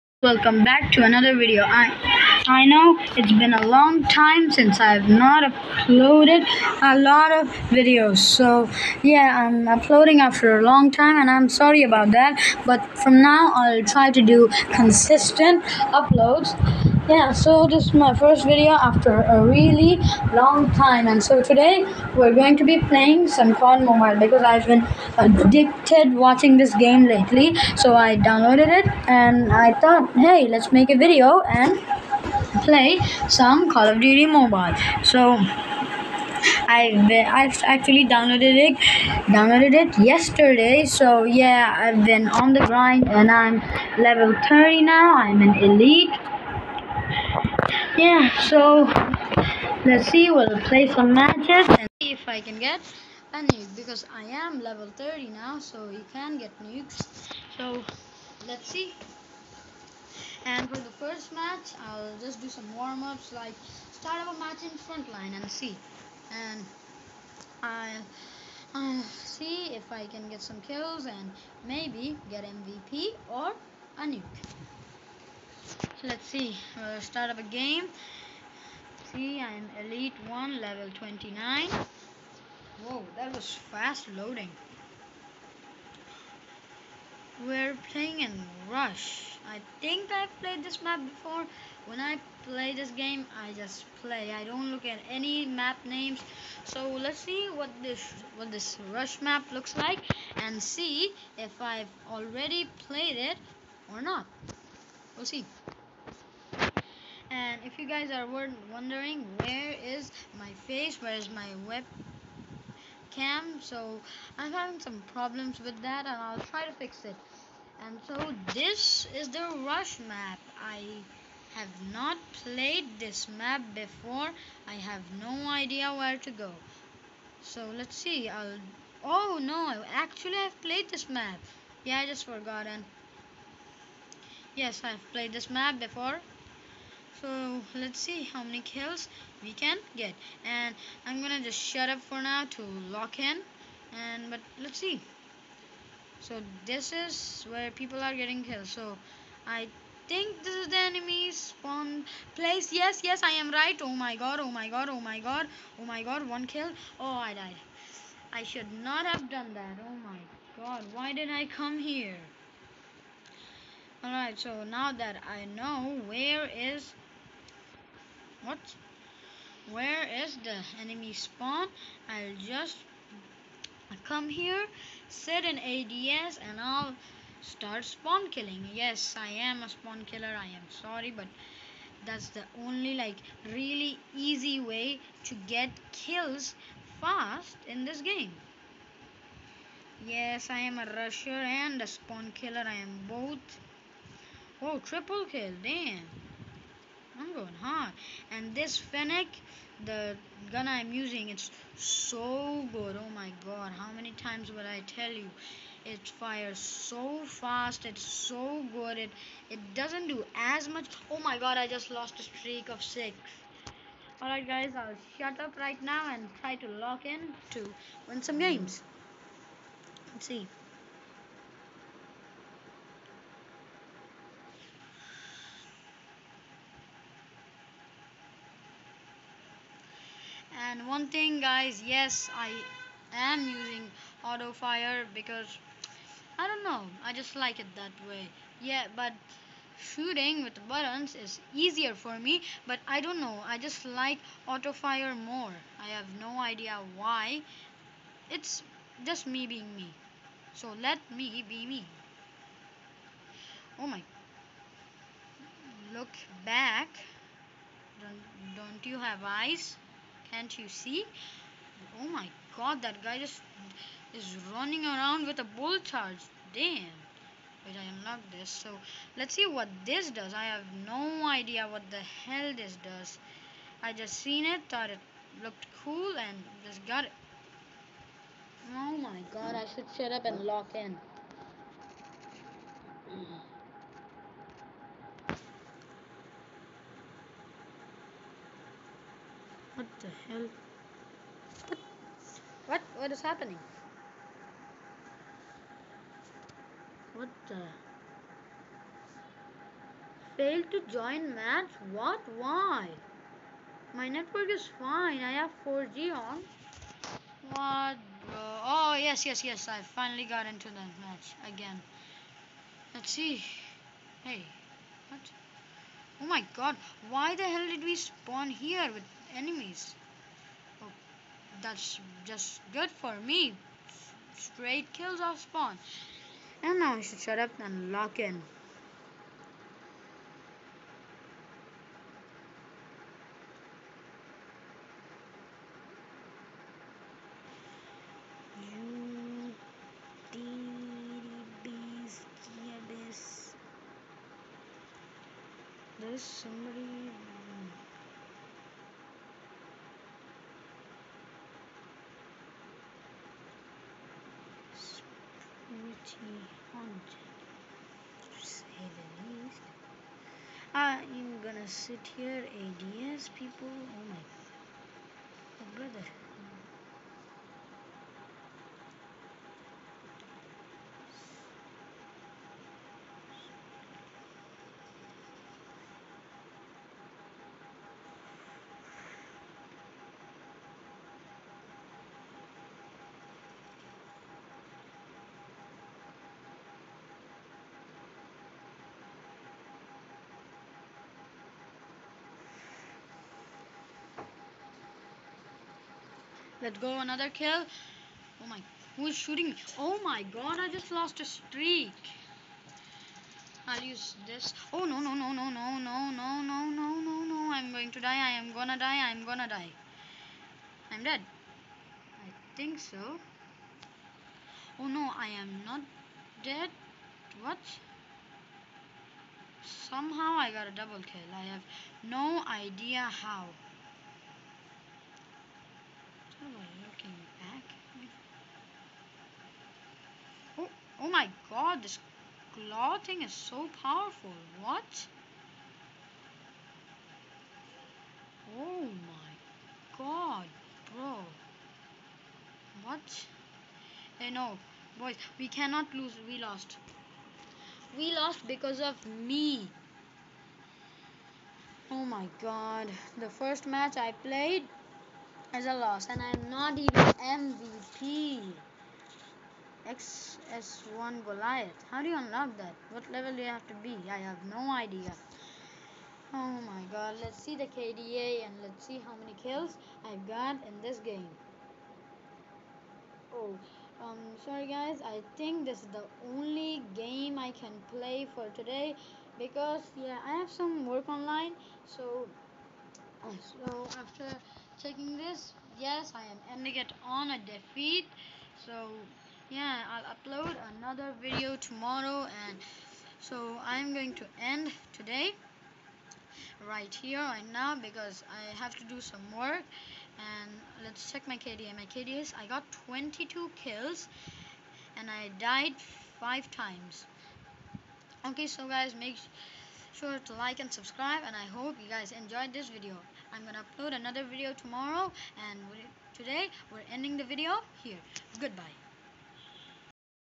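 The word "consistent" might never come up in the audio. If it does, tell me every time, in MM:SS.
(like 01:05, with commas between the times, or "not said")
00:14.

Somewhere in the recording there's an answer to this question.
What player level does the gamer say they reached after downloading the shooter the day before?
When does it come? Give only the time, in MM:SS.
00:44.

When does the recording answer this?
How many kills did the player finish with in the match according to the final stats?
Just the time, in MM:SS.
08:22.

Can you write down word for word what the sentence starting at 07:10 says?
Oh, oh my god, this claw thing is so powerful.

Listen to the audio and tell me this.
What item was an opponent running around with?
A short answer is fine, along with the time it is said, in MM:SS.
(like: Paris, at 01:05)
bull charge, at 04:25.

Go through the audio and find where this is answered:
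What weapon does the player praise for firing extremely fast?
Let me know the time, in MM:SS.
03:18.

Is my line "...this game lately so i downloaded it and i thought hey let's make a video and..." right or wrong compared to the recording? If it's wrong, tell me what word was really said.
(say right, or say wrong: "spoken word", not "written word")
right.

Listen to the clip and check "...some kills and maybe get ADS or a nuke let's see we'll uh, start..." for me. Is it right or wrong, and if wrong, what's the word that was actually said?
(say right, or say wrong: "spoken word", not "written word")
wrong: "MVP", not "ADS".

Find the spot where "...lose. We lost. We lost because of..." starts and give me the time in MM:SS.
07:25.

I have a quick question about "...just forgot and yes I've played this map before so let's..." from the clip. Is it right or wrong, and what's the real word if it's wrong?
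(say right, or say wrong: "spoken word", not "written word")
right.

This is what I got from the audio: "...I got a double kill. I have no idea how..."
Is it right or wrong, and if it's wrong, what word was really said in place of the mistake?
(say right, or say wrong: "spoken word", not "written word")
right.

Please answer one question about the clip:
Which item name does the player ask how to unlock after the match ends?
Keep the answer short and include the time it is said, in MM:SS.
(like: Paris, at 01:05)
XS1 Goliath, at 07:39.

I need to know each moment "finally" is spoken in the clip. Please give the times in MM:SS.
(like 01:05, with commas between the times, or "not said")
05:09.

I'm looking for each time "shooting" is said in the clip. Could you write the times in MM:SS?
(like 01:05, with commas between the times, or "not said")
03:59, 06:39.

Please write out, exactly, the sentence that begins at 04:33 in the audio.
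I just seen it, thought it looked cool, and just got it.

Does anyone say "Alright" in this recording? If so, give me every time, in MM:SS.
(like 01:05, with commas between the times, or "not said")
02:44, 03:34.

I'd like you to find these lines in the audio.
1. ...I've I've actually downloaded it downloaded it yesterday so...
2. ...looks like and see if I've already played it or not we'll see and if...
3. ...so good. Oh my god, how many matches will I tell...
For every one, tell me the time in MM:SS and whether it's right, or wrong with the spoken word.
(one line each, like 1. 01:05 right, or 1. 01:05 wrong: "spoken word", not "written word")
1. 00:36 right
2. 01:39 right
3. 03:21 wrong: "times", not "matches".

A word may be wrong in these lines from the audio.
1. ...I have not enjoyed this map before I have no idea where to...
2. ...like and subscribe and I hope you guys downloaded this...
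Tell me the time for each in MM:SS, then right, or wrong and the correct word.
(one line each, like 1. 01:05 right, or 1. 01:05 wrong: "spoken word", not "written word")
1. 02:00 wrong: "played", not "enjoyed"
2. 08:30 wrong: "enjoyed", not "downloaded".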